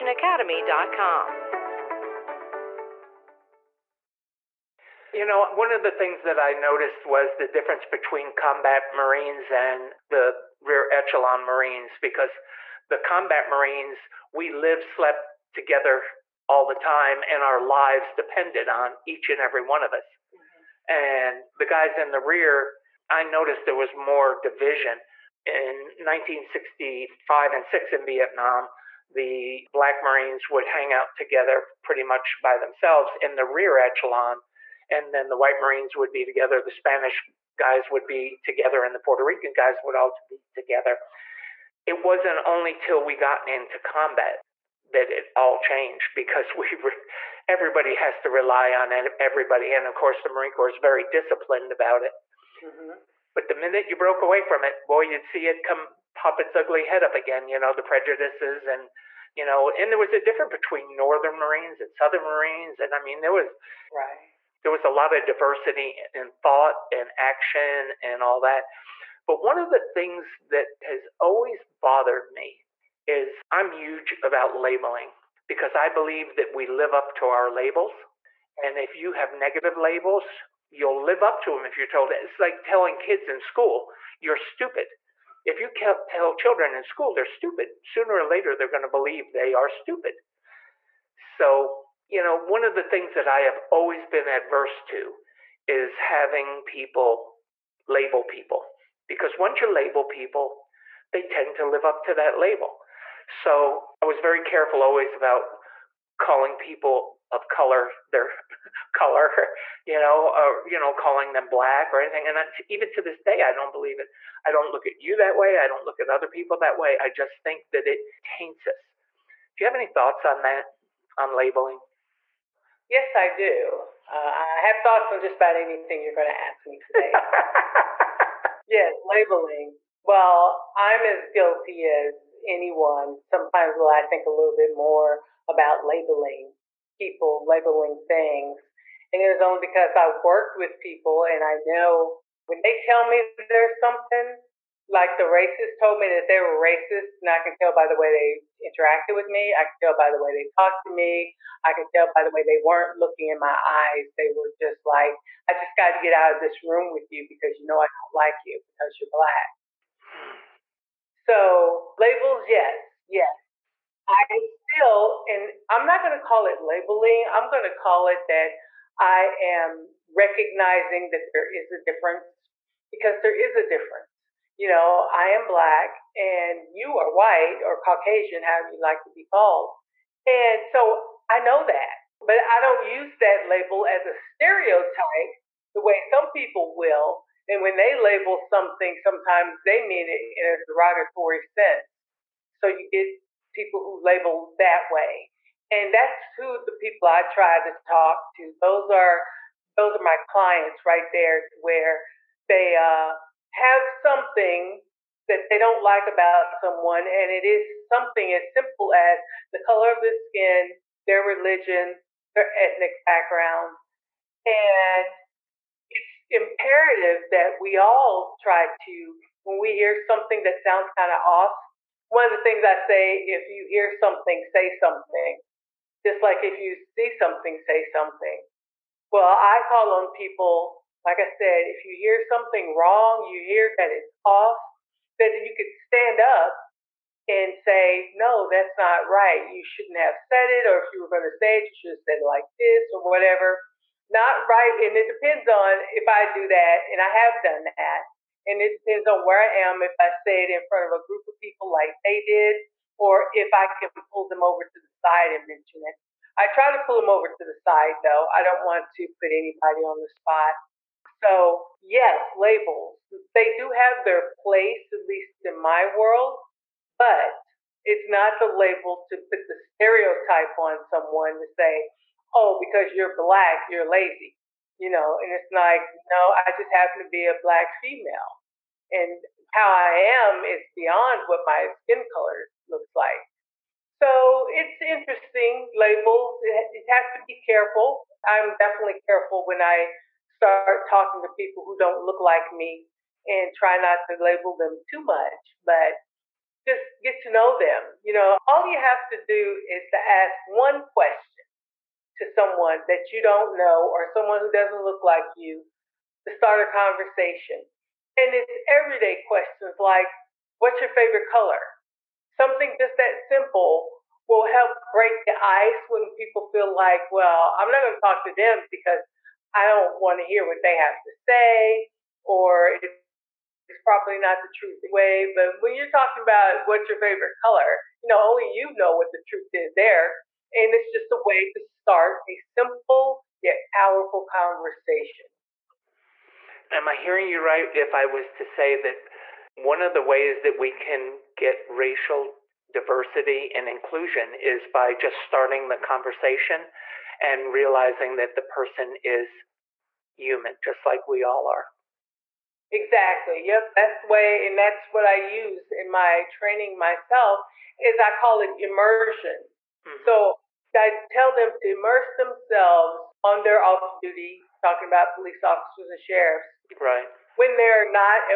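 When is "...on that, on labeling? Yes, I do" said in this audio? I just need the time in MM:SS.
02:00.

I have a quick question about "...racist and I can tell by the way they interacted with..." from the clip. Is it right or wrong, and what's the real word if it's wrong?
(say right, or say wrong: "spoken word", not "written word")
right.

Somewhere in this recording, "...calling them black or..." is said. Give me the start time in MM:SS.
01:50.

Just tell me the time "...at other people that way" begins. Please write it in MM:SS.
01:56.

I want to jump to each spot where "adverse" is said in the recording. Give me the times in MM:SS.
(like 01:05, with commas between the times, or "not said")
01:34.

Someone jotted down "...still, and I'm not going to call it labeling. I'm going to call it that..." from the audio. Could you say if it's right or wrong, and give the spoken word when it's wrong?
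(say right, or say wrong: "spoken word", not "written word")
right.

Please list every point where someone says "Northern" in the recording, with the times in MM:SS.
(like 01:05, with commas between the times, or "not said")
01:00.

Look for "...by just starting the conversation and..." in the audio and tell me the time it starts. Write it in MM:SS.
05:44.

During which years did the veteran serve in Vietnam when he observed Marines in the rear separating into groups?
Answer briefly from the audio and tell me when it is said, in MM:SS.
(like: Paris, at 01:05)
1965 and 1966, at 00:25.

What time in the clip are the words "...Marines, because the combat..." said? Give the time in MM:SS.
00:11.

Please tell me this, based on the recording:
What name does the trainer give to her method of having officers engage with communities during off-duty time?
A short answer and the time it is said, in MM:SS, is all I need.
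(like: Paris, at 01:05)
Immersion, at 05:58.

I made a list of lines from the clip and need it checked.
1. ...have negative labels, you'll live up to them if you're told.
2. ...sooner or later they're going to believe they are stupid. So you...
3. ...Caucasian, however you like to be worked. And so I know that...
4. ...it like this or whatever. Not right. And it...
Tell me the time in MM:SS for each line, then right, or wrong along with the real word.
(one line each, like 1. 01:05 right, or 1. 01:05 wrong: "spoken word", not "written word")
1. 01:19 right
2. 01:27 right
3. 02:57 wrong: "called", not "worked"
4. 04:02 right.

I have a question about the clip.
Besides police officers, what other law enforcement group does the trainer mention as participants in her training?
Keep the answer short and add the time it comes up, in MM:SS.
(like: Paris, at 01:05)
Sheriffs, at 06:05.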